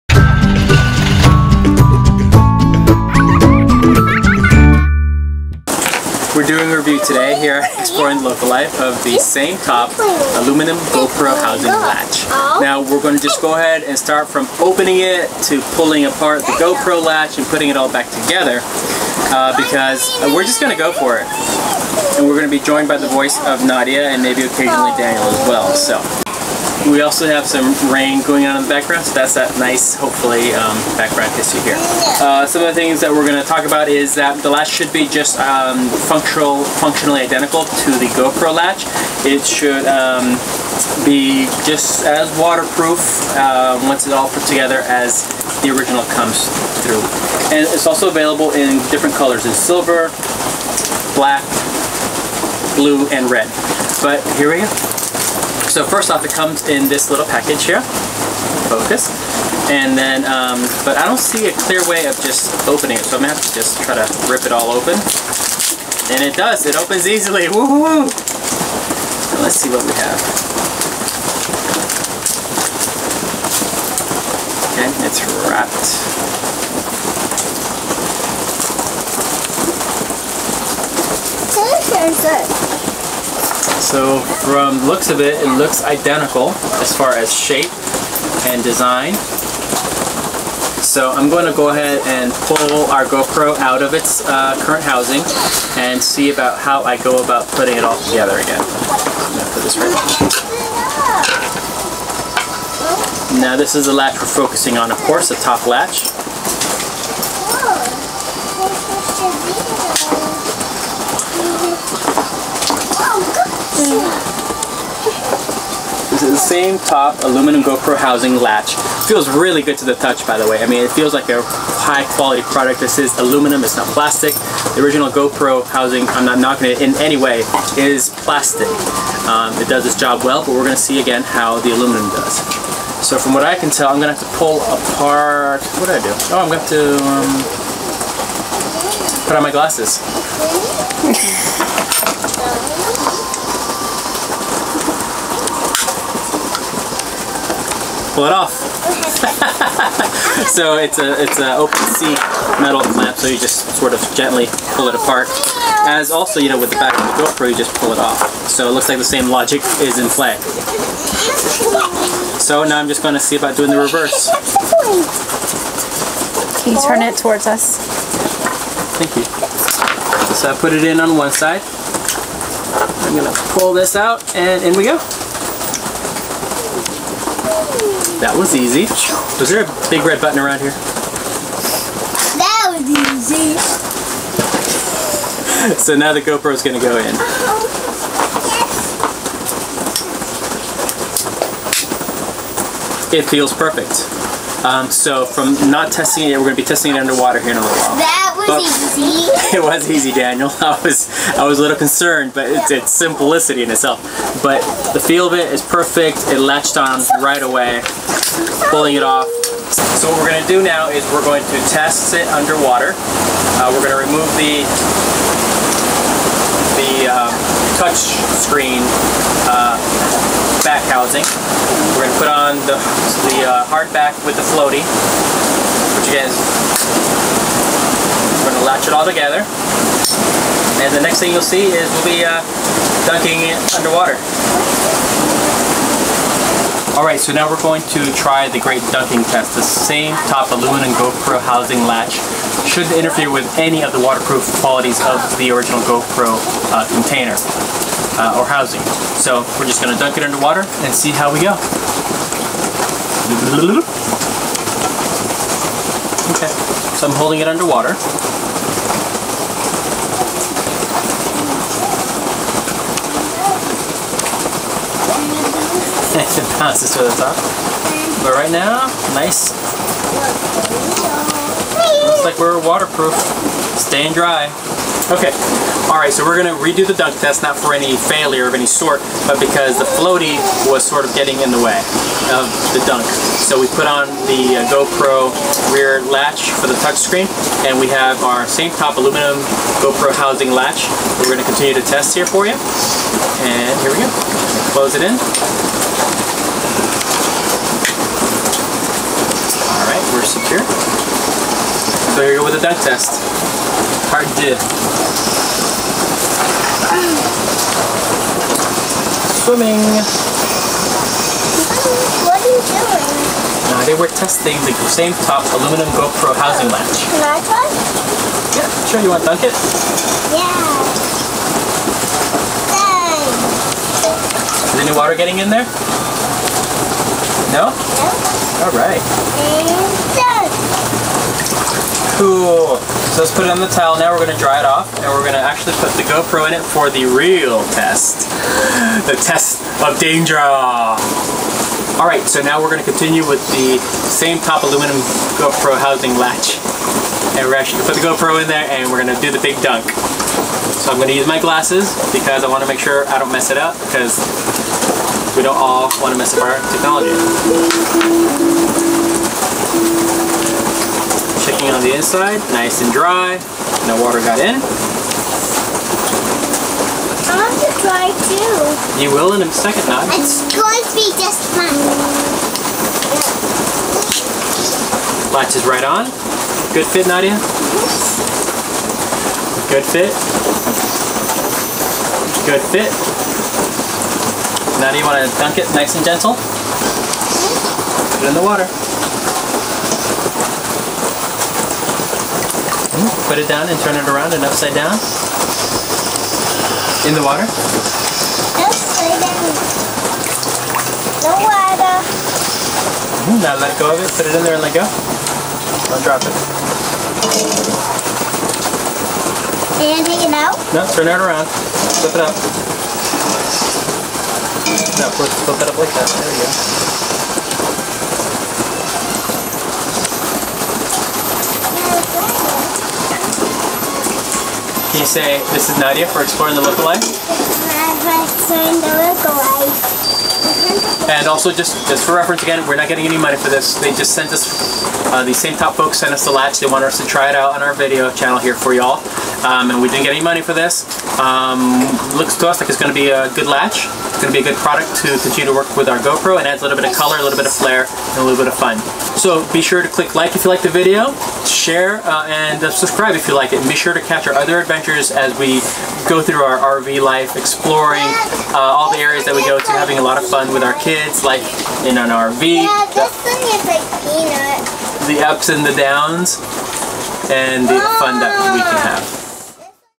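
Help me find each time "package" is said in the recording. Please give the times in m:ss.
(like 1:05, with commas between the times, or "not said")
0:57.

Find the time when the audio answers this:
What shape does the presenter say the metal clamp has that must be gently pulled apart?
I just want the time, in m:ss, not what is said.
2:31.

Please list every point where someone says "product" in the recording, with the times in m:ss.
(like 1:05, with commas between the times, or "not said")
2:02, 7:24.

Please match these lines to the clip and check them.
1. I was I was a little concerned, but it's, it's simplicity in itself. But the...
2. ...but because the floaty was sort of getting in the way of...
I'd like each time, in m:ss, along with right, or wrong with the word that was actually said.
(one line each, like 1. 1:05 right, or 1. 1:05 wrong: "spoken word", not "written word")
1. 3:20 right
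2. 4:39 right.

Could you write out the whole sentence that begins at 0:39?
It should um, be just as waterproof uh, once it's all put together as the original comes through.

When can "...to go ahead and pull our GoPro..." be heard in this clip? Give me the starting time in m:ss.
1:31.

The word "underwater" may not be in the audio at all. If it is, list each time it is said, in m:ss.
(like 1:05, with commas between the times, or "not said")
3:16, 3:32, 3:53, 4:10, 4:17.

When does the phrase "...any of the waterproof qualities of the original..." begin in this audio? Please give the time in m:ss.
4:03.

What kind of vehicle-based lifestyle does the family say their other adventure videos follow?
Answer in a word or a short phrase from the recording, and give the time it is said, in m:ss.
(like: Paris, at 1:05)
RV life, at 7:36.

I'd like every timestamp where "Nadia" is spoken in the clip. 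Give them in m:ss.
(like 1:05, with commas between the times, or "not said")
0:23, 6:17, 7:05.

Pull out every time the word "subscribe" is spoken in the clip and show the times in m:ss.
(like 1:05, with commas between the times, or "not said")
7:32.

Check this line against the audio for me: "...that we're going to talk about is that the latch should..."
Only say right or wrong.
right.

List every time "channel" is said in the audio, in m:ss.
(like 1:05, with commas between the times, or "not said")
7:18.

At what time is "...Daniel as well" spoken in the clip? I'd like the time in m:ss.
0:24.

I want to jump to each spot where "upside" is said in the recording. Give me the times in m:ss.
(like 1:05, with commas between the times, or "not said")
6:34, 6:38.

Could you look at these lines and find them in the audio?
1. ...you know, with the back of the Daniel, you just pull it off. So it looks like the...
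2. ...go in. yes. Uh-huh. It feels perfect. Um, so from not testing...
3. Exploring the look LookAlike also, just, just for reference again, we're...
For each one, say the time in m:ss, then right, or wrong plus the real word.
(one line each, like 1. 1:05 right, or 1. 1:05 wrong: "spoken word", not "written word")
1. 2:36 wrong: "GoPro", not "Daniel"
2. 3:06 right
3. 7:06 wrong: "And", not "LookAlike".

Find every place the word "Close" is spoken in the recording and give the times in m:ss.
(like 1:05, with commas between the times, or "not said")
4:54.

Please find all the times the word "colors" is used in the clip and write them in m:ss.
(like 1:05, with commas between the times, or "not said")
0:49, 7:26.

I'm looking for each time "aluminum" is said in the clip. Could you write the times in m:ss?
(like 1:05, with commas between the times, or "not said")
0:10, 1:57, 2:03, 2:11, 4:00, 4:48, 5:15, 5:44.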